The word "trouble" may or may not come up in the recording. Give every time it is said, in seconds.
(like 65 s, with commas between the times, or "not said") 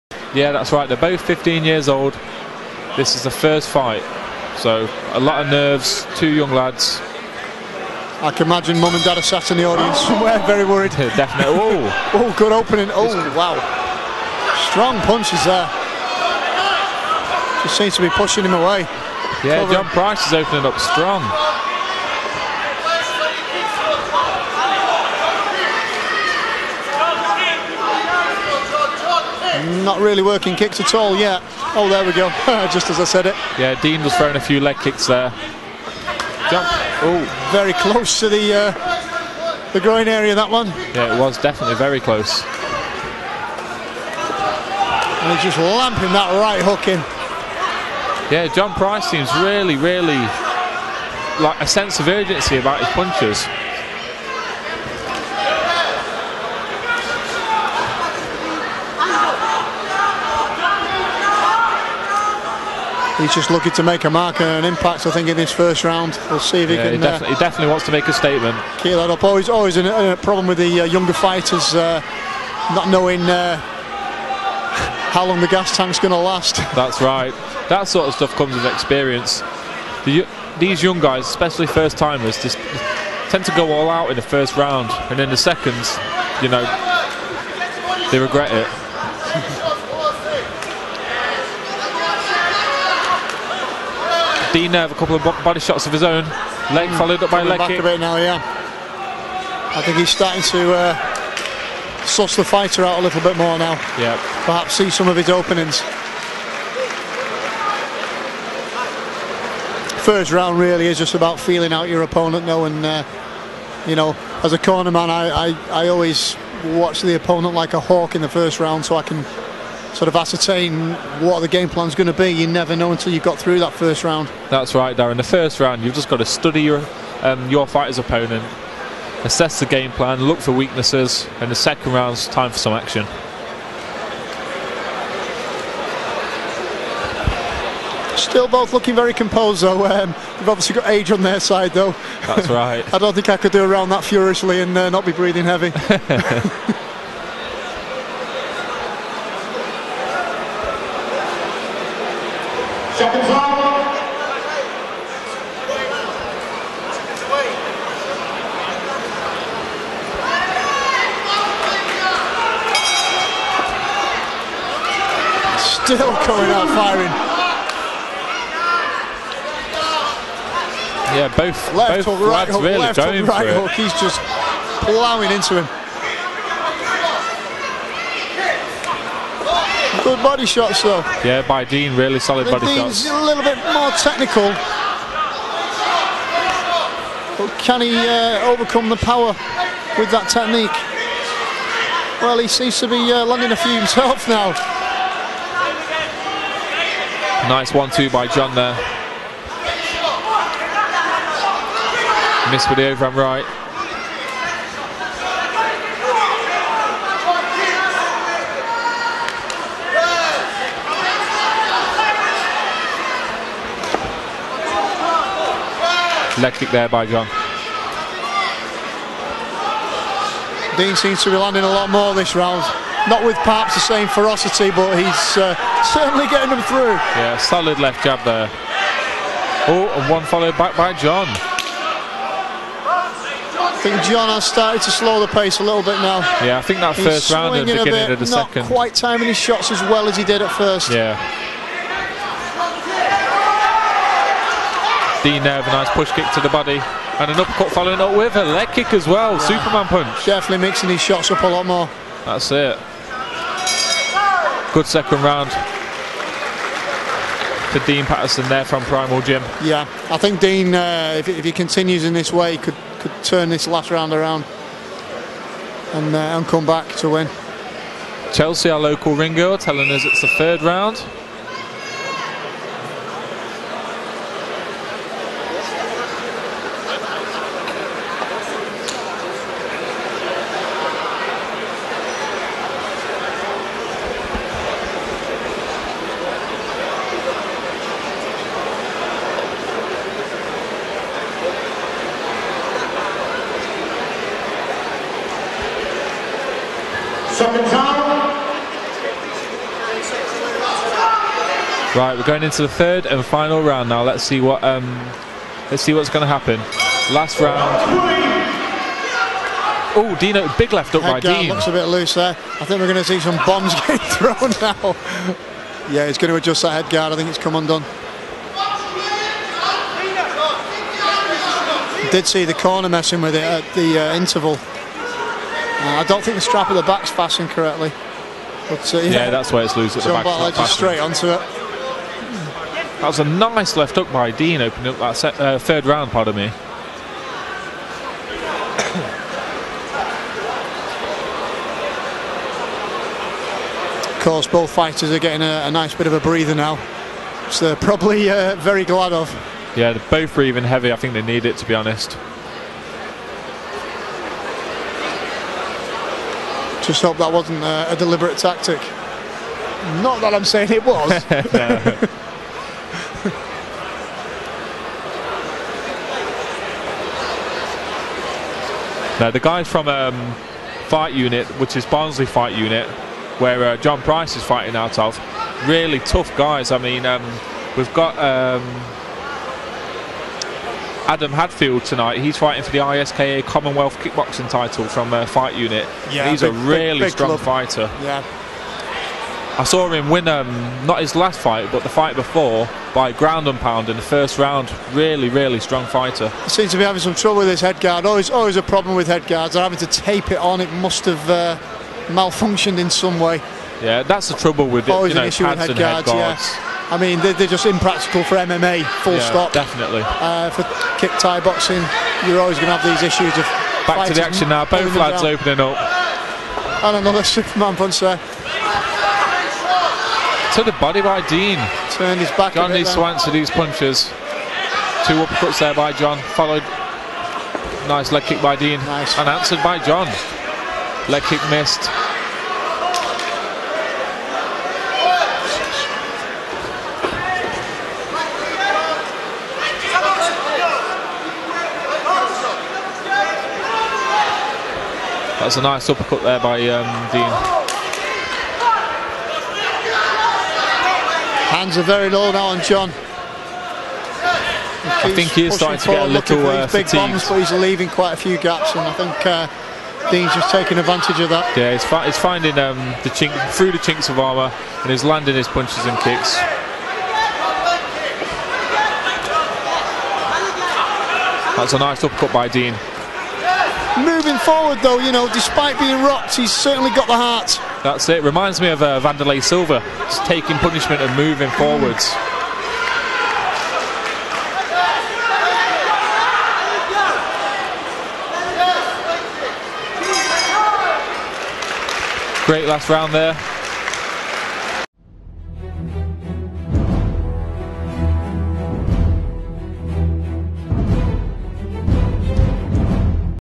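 397 s, 404 s.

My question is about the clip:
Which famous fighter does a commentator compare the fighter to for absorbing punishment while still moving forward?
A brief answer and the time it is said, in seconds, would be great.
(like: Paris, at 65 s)
Wanderlei Silva, at 479 s.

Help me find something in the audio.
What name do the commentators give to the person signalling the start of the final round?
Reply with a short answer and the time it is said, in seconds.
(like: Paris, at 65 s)
Chelsea, at 268 s.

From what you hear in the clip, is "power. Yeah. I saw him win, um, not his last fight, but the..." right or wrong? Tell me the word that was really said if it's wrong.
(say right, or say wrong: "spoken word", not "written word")
wrong: "fighter", not "power".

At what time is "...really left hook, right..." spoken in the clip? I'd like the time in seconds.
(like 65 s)
172 s.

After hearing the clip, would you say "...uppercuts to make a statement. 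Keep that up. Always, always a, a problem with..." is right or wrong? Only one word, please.
wrong.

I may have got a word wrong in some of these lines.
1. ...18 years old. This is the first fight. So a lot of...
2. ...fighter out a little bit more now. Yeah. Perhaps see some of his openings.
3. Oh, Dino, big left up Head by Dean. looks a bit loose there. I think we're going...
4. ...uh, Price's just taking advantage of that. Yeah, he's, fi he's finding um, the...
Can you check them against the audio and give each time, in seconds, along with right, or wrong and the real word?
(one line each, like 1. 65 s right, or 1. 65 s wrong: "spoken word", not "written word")
1. 1 s wrong: "15", not "18"
2. 102 s right
3. 309 s right
4. 459 s wrong: "Dean", not "Price".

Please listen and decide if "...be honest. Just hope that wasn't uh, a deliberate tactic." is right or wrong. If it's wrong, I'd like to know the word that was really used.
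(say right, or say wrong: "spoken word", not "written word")
right.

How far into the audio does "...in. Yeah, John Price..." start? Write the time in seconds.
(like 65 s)
46 s.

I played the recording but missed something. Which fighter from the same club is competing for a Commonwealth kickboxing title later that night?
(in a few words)
Adam Hadfield.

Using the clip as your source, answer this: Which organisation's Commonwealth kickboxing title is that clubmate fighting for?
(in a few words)
ISKA.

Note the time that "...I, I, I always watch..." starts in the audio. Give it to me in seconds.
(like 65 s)
115 s.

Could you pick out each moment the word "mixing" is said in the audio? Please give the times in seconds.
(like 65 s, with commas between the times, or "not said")
250 s.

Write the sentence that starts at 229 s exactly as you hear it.
Oh, and one followed back by John.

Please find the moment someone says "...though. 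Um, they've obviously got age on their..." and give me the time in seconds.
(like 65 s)
139 s.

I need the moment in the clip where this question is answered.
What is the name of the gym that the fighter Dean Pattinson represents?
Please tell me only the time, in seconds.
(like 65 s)
258 s.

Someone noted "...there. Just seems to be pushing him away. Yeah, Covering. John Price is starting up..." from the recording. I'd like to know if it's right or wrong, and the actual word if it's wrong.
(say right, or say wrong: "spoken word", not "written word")
wrong: "opening", not "starting".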